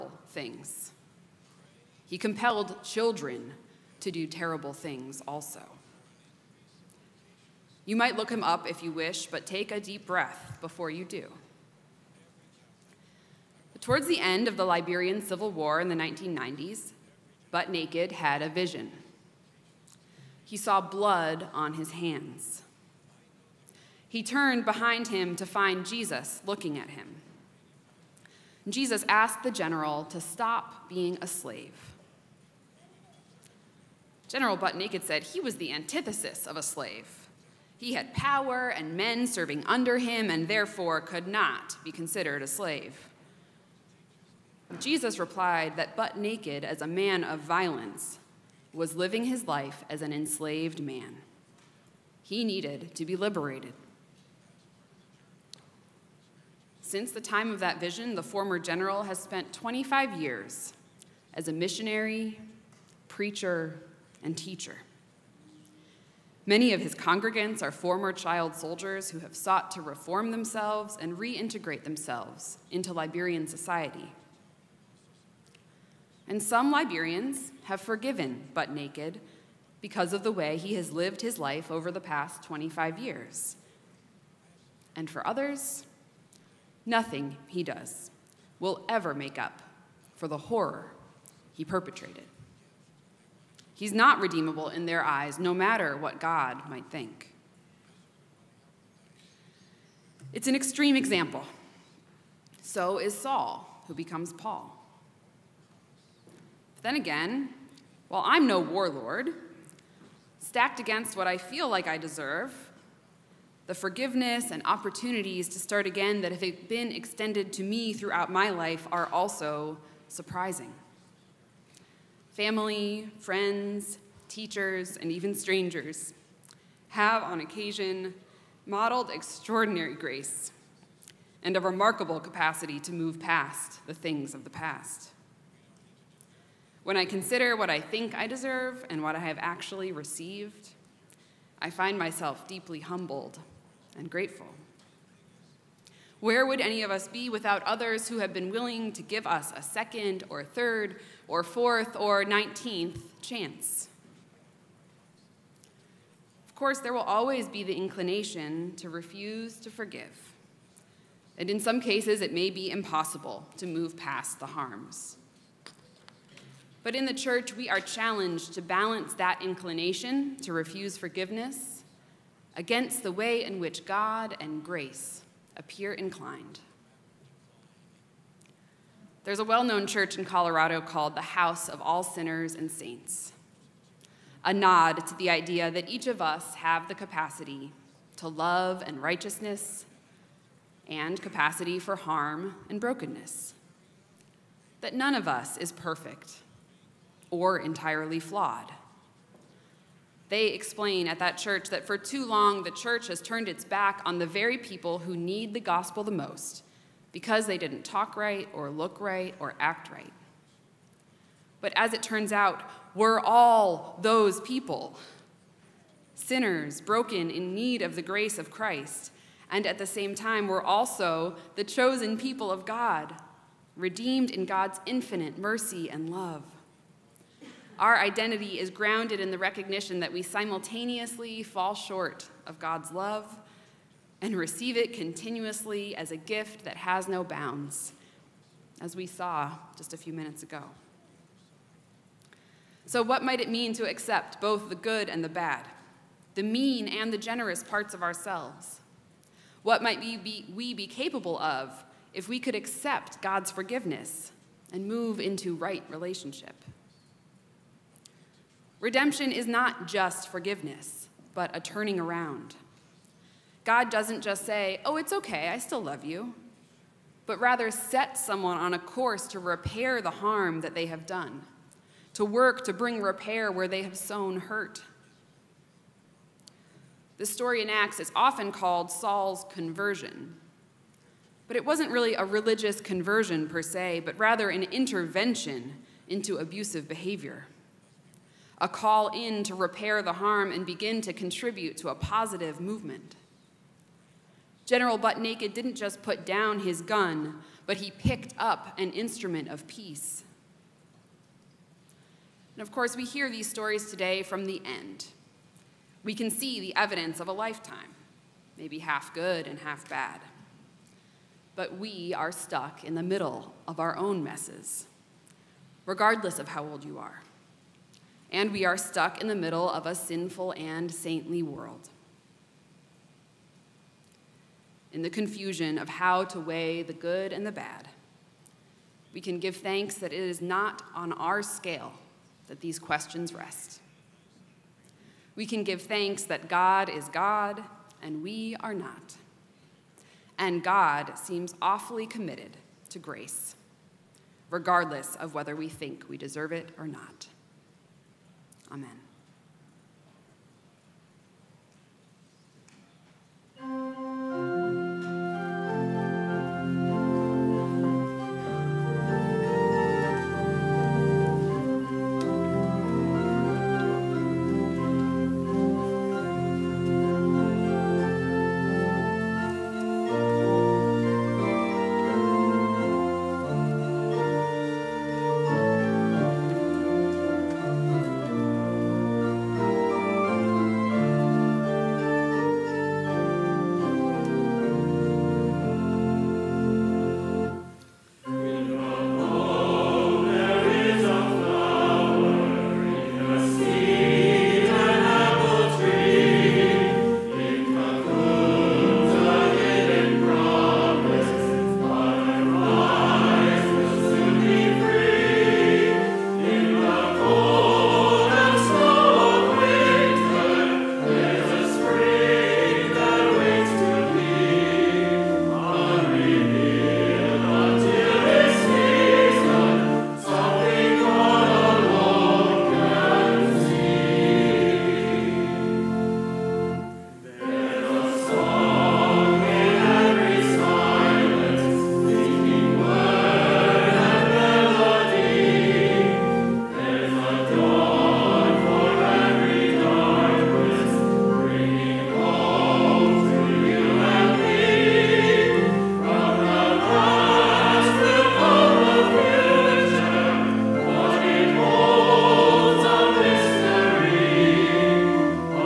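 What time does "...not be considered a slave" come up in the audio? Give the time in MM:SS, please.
00:41.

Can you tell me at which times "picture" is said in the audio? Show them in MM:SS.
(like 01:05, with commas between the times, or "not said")
not said.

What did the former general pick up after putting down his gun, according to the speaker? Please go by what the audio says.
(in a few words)
an instrument of peace.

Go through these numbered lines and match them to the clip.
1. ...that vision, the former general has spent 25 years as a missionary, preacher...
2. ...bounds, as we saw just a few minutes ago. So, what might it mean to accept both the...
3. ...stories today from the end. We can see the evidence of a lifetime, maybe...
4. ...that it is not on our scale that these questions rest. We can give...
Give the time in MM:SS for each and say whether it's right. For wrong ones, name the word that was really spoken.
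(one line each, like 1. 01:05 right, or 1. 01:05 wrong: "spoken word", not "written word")
1. 00:57 right
2. 03:57 right
3. 05:03 right
4. 05:29 right.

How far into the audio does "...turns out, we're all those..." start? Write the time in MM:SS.
03:32.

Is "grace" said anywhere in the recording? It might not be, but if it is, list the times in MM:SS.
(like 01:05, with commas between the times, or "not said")
02:09, 02:54, 03:38, 05:42.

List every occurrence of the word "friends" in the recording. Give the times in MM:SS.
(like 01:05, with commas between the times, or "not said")
02:03.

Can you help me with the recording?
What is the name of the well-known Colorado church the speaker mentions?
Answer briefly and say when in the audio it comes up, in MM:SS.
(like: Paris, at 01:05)
House of All Sinners and Saints, at 03:01.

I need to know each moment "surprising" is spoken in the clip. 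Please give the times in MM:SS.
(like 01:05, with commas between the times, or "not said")
02:00.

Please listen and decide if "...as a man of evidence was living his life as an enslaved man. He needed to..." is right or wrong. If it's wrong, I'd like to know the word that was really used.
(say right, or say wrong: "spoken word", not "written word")
wrong: "violence", not "evidence".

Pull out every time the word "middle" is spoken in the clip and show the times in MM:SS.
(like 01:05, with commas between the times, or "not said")
05:13, 05:19.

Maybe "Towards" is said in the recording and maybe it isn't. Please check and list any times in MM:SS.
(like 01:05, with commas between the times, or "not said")
00:13.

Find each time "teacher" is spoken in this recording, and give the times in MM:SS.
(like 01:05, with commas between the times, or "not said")
01:04, 02:04.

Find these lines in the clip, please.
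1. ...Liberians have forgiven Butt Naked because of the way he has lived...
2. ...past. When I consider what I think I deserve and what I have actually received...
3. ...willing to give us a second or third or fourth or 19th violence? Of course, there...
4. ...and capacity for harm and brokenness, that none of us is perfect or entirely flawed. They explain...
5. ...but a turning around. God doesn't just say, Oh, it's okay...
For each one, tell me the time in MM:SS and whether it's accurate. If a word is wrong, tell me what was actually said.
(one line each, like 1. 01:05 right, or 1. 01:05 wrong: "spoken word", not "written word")
1. 01:16 right
2. 02:14 right
3. 02:28 wrong: "chance", not "violence"
4. 03:10 right
5. 04:21 right.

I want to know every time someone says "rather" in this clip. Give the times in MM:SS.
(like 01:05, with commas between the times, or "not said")
04:27, 04:44.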